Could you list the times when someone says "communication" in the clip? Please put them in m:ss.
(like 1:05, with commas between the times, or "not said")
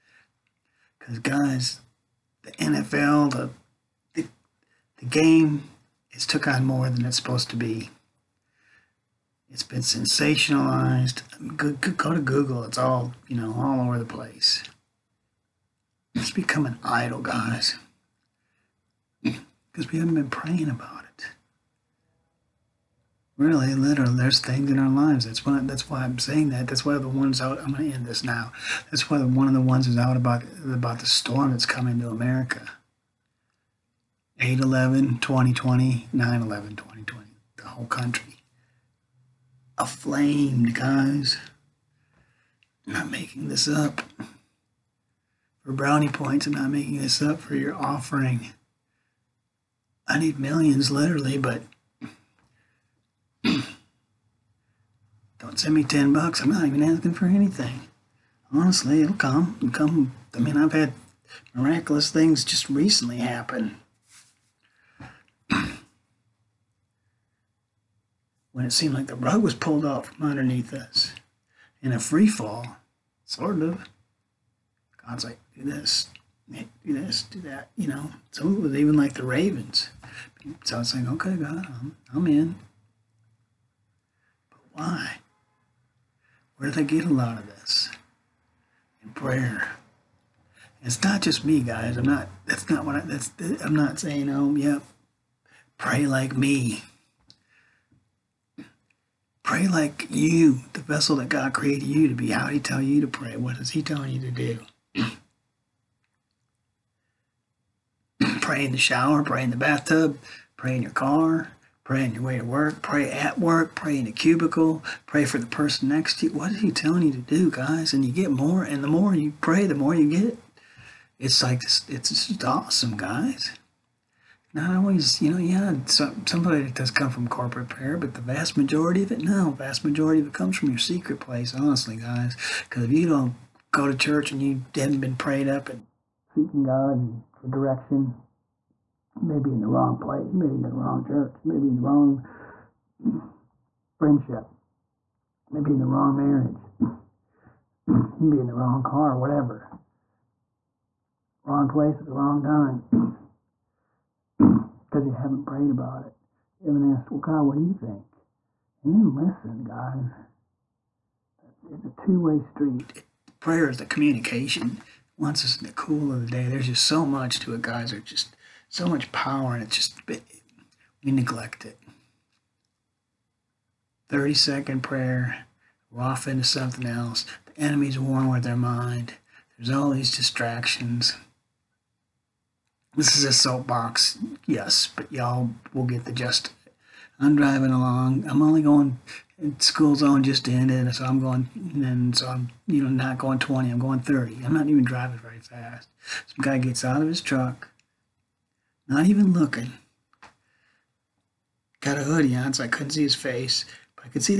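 2:43.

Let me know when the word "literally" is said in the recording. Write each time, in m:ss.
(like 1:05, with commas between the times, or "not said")
0:23, 0:50.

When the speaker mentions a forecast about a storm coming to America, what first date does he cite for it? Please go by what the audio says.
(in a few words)
8-11, 2020.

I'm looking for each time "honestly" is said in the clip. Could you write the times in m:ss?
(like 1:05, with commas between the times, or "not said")
0:58, 2:11.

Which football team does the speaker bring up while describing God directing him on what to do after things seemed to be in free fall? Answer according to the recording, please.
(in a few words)
Ravens.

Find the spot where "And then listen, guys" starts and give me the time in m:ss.
2:38.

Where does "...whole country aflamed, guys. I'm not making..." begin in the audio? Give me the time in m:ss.
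0:37.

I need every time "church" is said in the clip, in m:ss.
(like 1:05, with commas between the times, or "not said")
2:13, 2:21.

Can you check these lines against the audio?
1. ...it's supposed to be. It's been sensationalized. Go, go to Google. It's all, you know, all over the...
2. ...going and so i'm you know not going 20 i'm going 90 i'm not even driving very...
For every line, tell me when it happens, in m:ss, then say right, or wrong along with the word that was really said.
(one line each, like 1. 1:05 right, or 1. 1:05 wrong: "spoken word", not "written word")
1. 0:07 right
2. 3:11 wrong: "30", not "90".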